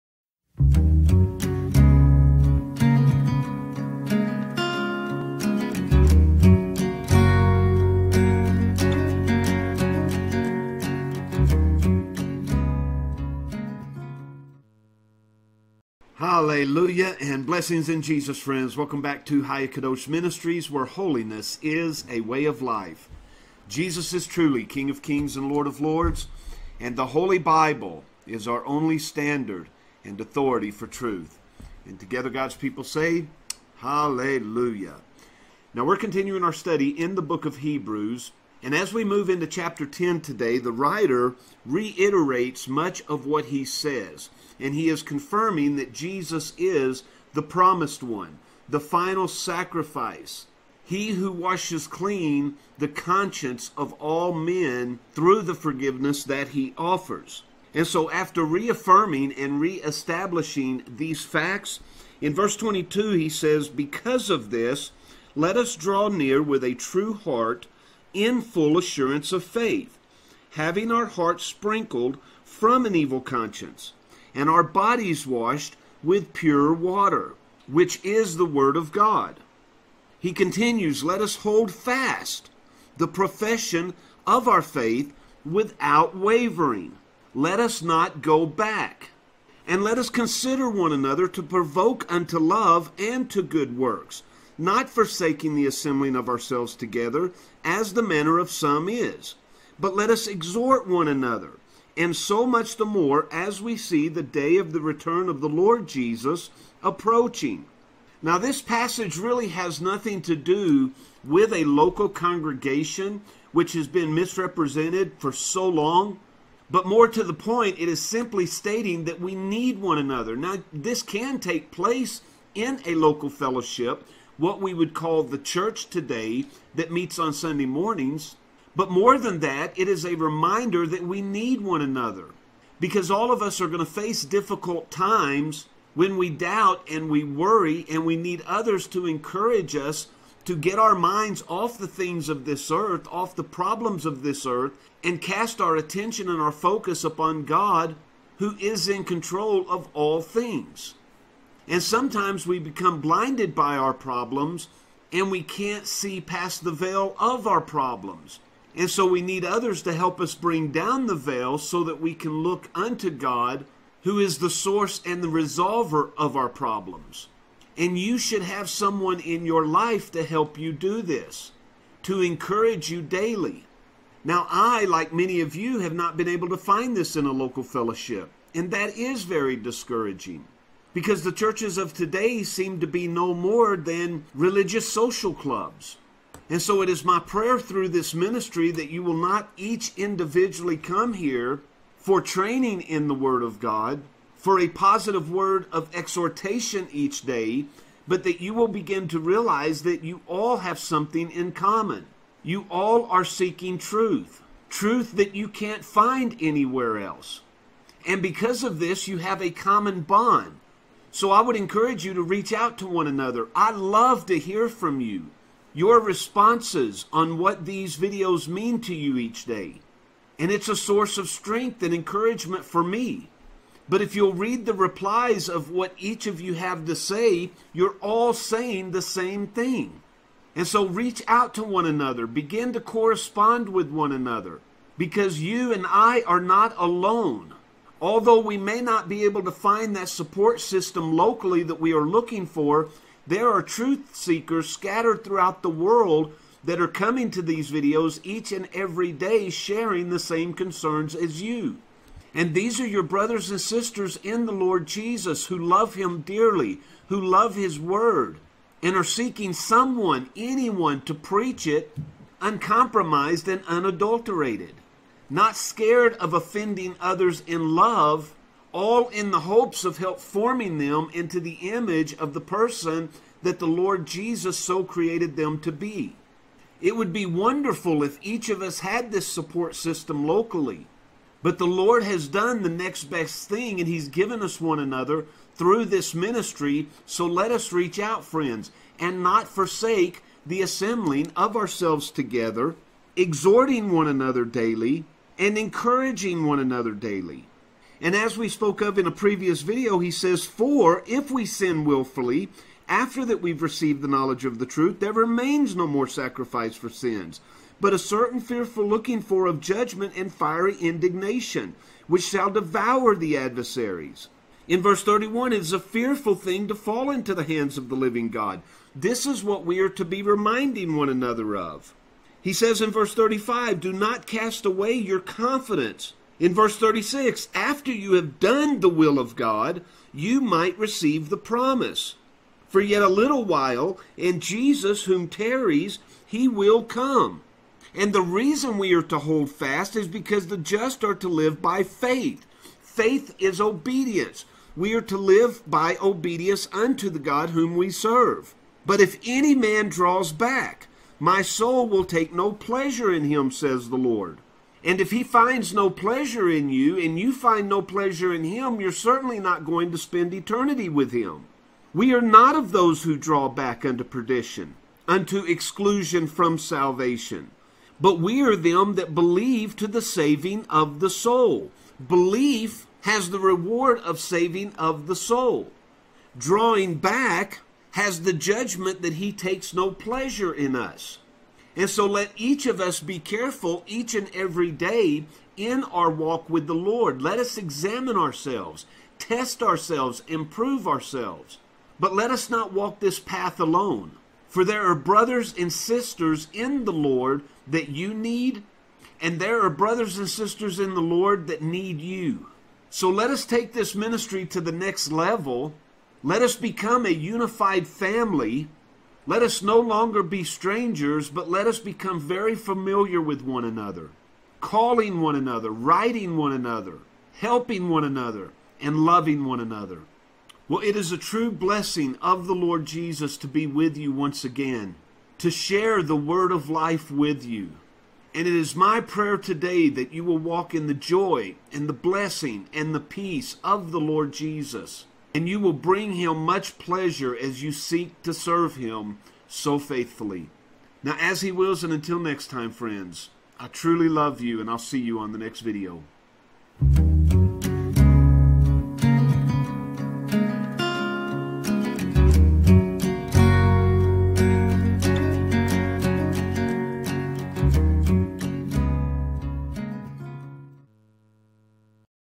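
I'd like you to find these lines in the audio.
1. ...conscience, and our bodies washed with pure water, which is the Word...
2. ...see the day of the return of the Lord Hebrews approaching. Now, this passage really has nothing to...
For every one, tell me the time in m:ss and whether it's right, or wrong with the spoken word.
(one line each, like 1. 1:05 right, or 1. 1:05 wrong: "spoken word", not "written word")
1. 1:13 right
2. 1:43 wrong: "Jesus", not "Hebrews".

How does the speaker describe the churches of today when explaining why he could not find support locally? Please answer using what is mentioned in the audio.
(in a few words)
Religious social clubs.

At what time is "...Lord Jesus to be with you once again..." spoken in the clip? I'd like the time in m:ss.
7:02.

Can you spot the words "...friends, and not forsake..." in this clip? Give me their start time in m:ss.
4:48.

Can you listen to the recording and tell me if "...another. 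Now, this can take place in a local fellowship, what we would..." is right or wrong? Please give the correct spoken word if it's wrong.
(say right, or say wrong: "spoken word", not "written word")
right.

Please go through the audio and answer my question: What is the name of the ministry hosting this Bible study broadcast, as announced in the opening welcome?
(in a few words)
High Ministries.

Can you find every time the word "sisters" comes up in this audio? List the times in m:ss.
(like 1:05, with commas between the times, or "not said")
4:13, 6:35, 6:40.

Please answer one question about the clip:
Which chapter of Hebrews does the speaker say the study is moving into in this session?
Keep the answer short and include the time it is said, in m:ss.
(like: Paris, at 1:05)
10, at 0:39.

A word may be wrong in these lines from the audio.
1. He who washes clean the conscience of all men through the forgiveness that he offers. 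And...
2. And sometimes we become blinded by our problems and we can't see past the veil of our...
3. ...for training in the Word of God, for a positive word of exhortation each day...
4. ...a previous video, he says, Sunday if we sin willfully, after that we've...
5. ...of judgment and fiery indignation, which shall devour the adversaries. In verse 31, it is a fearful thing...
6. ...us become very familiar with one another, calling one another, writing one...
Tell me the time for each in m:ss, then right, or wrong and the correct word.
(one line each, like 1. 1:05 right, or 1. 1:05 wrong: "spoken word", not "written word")
1. 0:50 right
2. 2:31 right
3. 3:11 right
4. 4:59 wrong: "For", not "Sunday"
5. 5:09 right
6. 6:51 right.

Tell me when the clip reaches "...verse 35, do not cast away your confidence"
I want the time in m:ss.
5:22.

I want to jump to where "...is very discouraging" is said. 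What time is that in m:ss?
2:58.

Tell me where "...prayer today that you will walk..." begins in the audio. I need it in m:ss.
7:09.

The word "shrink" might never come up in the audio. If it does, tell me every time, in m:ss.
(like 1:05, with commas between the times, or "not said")
not said.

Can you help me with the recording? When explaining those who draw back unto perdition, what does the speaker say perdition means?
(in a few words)
Exclusion from salvation.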